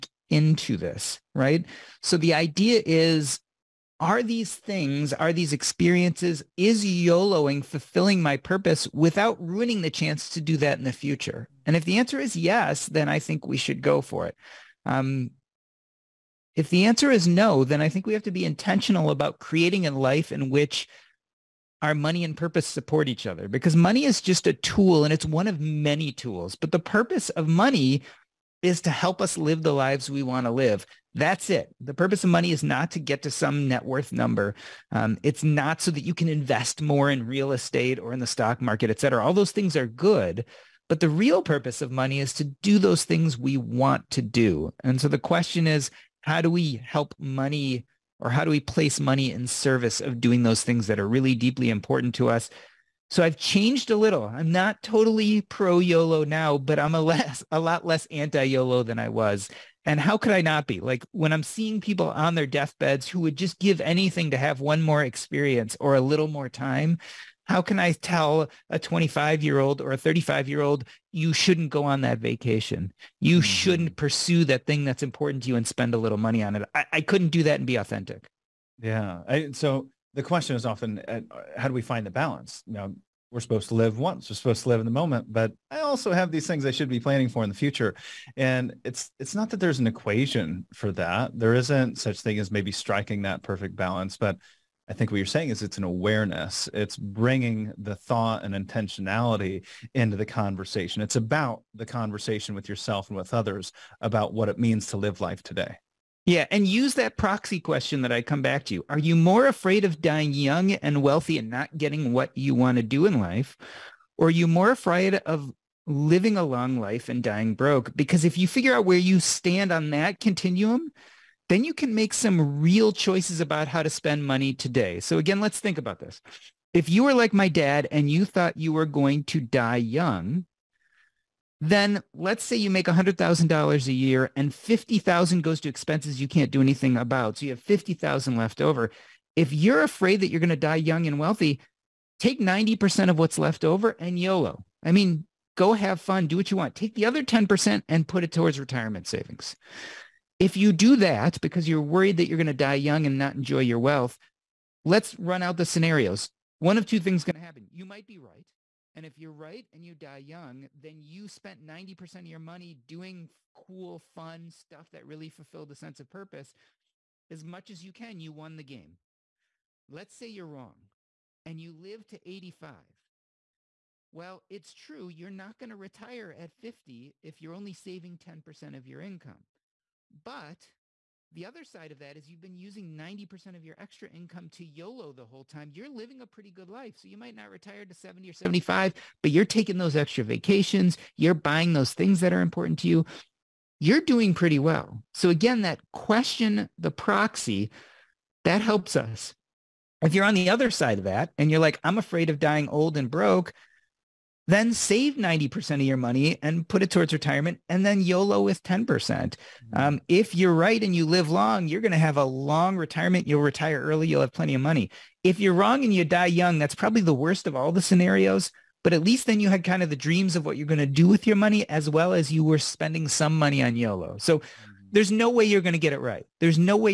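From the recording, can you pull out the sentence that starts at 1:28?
And it's it's not that there's an equation for that.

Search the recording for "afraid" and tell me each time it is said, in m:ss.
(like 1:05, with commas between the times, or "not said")
1:49, 1:54, 2:19, 3:21.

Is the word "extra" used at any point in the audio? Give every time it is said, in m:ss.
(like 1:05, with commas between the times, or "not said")
3:03, 3:09.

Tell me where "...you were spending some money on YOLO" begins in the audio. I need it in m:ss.
3:42.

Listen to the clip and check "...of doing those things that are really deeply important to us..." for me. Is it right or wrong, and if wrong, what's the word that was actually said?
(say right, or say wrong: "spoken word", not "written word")
right.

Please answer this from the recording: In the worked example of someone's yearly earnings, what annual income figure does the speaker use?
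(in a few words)
$100,000.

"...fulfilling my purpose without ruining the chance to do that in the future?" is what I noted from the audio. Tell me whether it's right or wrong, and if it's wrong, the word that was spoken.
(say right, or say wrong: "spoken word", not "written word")
right.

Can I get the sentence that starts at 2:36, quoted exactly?
One of two things is going to happen.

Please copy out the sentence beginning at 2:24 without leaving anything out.
I mean, go have fun, do what you want.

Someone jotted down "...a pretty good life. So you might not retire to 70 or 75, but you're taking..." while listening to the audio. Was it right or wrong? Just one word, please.
right.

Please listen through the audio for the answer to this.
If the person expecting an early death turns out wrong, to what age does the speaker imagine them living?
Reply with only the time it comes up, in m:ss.
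2:52.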